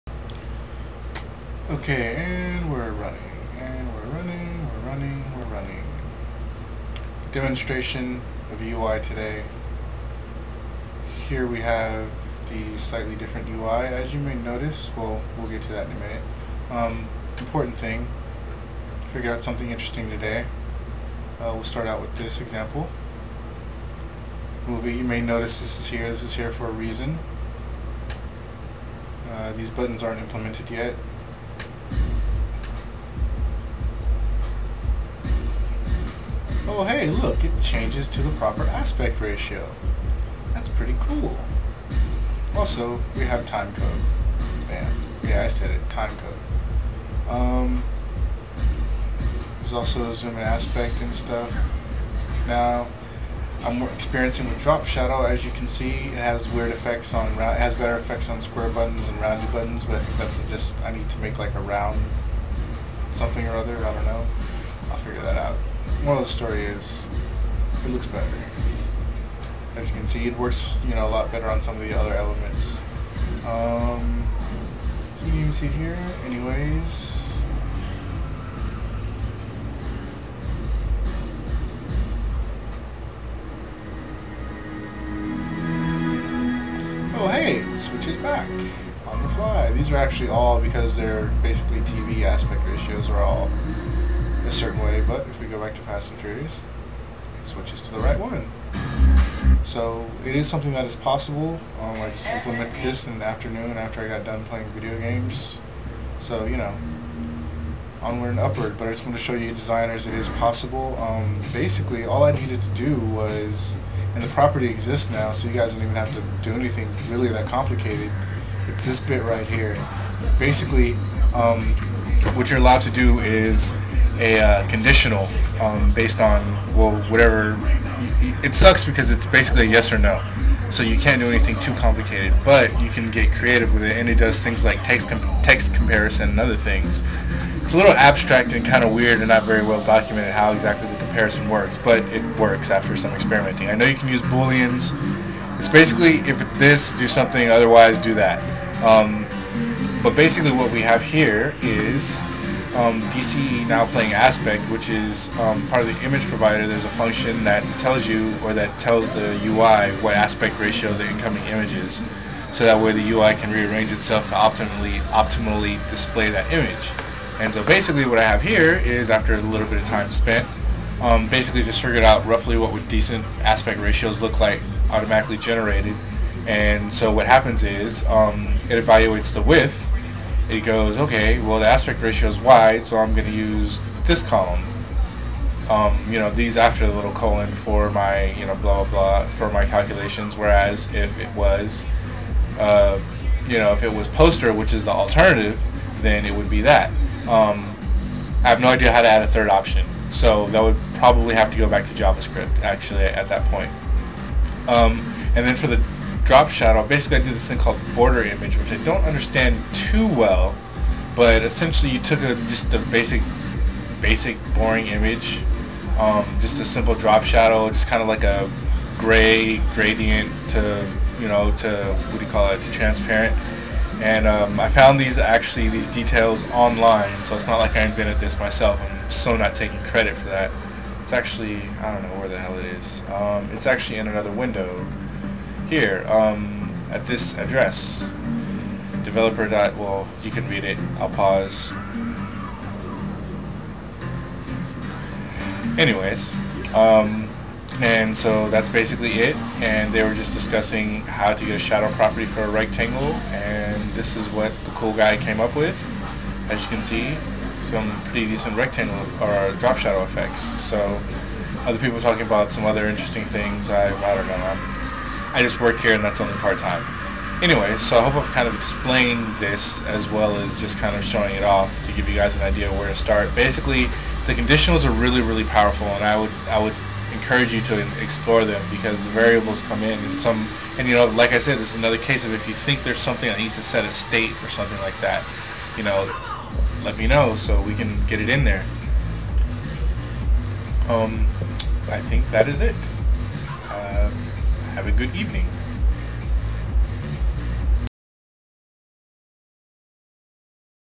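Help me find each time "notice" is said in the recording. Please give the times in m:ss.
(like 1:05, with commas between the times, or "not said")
0:14, 0:25.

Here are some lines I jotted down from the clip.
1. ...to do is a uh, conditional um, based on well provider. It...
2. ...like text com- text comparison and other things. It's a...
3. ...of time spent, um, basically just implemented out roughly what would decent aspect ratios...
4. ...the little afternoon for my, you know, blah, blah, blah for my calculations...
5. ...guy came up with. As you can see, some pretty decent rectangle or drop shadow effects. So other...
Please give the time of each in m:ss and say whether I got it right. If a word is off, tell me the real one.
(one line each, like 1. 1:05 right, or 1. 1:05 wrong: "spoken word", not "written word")
1. 2:02 wrong: "whatever", not "provider"
2. 2:14 right
3. 2:49 wrong: "figured", not "implemented"
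4. 3:06 wrong: "colon", not "afternoon"
5. 4:14 right.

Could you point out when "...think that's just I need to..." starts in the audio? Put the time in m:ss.
0:59.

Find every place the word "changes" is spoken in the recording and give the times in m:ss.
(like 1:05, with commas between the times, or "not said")
0:37.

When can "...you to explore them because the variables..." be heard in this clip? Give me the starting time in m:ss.
4:37.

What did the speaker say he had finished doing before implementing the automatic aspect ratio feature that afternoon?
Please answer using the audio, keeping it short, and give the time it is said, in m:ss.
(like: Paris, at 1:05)
playing video games, at 1:44.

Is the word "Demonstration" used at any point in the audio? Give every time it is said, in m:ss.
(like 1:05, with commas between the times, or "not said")
0:07.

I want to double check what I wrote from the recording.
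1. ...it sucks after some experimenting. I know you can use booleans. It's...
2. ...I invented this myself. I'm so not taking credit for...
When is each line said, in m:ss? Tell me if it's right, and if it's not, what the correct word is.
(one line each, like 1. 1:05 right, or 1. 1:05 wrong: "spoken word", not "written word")
1. 2:22 wrong: "works", not "sucks"
2. 3:47 right.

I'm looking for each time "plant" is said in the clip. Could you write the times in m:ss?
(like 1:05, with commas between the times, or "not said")
not said.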